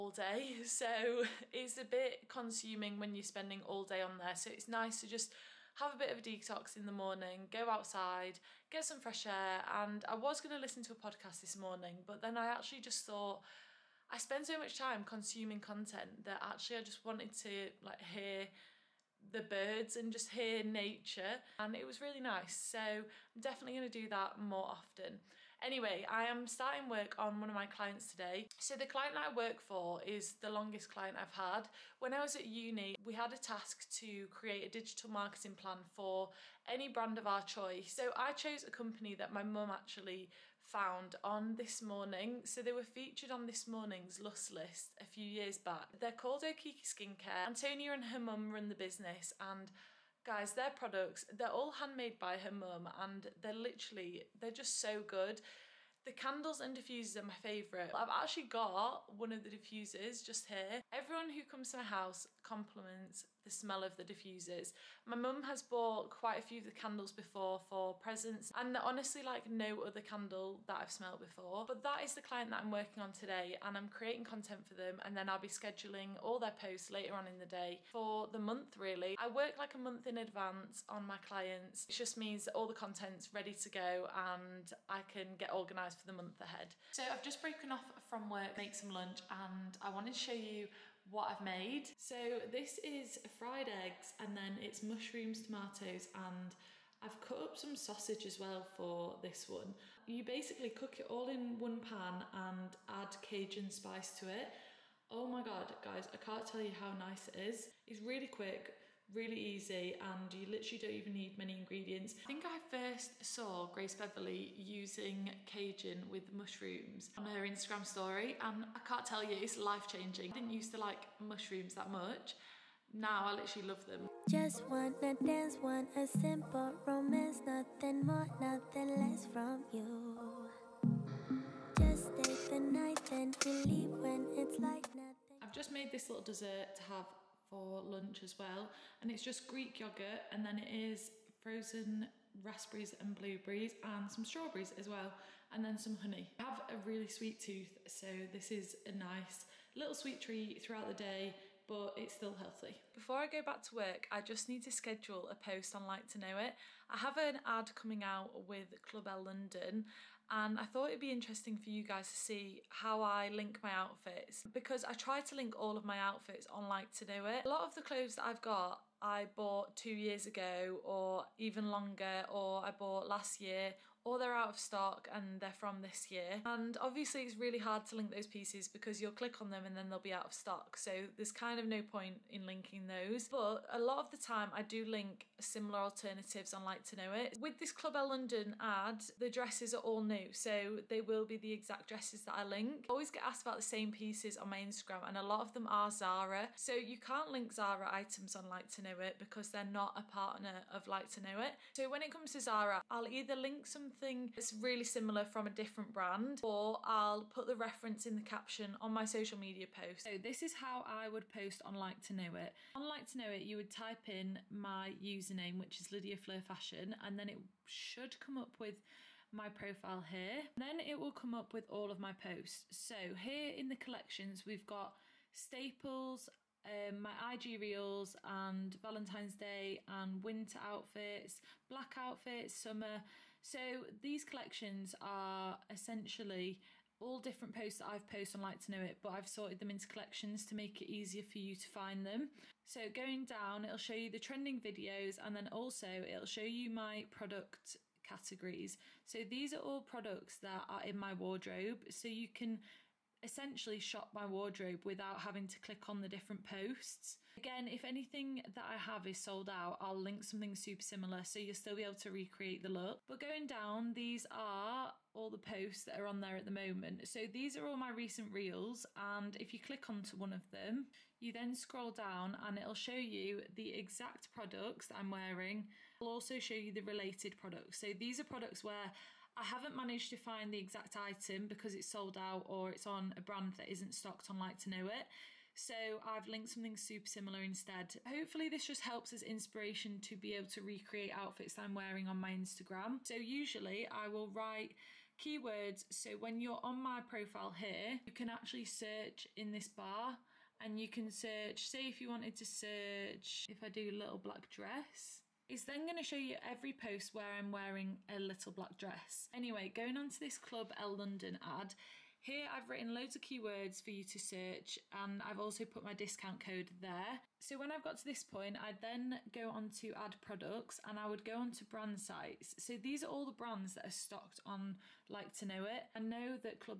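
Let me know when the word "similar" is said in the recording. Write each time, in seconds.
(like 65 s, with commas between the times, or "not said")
185 s, 204 s, 260 s, 287 s.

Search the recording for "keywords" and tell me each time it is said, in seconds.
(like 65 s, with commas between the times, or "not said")
295 s, 313 s.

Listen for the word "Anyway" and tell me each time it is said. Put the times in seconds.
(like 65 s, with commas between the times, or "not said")
25 s, 309 s.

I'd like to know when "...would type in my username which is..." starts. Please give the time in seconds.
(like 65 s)
213 s.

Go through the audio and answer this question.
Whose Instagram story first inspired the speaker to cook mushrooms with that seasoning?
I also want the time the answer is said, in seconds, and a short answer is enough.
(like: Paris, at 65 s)
Grace Beverley, at 113 s.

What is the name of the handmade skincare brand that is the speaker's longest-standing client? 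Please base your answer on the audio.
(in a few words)
Okiki Skincare.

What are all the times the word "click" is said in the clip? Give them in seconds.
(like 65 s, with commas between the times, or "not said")
179 s, 255 s, 269 s.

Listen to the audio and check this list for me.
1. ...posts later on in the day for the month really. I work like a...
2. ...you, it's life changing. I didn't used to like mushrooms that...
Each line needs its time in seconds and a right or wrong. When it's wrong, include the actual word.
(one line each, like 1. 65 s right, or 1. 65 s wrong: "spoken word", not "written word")
1. 76 s right
2. 119 s right.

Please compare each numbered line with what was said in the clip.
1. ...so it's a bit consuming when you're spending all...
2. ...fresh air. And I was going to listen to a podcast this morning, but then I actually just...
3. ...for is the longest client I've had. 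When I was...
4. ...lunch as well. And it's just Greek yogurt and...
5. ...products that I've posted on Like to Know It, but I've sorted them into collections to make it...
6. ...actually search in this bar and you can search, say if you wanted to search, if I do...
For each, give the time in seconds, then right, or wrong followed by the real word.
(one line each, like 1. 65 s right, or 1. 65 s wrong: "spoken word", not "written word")
1. 0 s right
2. 9 s right
3. 29 s right
4. 137 s right
5. 237 s wrong: "posts", not "products"
6. 298 s right.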